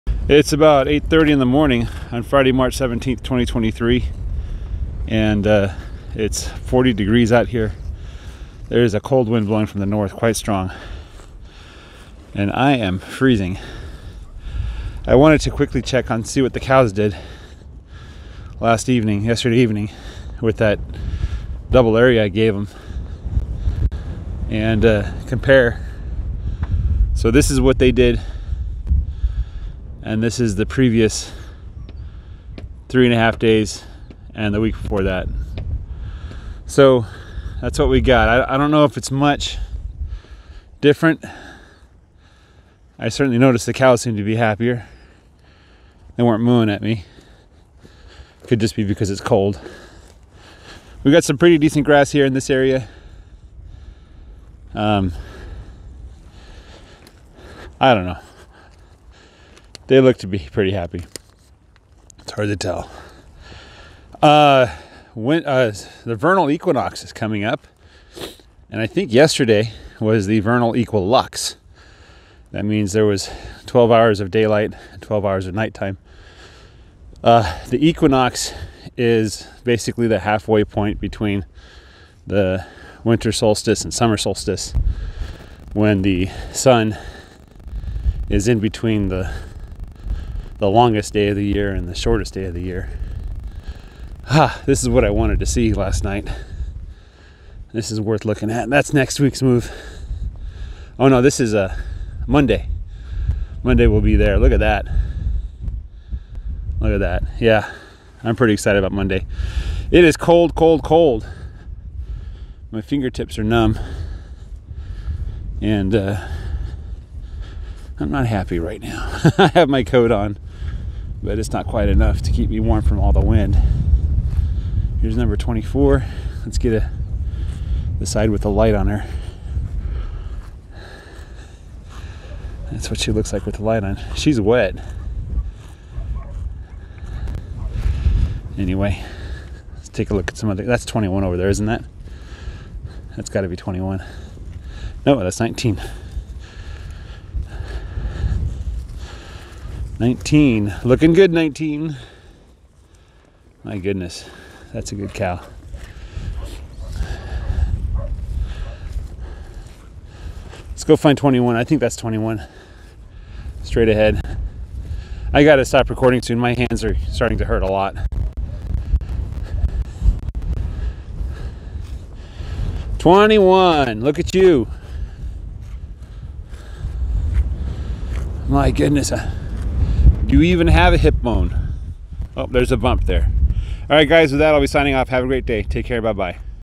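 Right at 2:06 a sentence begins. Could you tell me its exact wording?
Let's get a, the side with the light on her.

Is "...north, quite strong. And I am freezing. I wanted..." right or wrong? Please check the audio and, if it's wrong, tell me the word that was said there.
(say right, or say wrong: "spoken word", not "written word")
right.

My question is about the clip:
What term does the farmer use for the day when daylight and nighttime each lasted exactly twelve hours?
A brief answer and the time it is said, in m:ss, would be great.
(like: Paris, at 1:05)
vernal equilux, at 1:10.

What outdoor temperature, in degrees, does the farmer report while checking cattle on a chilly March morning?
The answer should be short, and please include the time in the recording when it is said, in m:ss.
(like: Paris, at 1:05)
40, at 0:06.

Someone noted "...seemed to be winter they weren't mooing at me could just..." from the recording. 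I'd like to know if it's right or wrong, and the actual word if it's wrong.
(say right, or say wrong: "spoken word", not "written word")
wrong: "happier", not "winter".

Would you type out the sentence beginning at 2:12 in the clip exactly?
That's what she looks like with the light on.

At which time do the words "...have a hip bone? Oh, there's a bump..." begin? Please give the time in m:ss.
3:00.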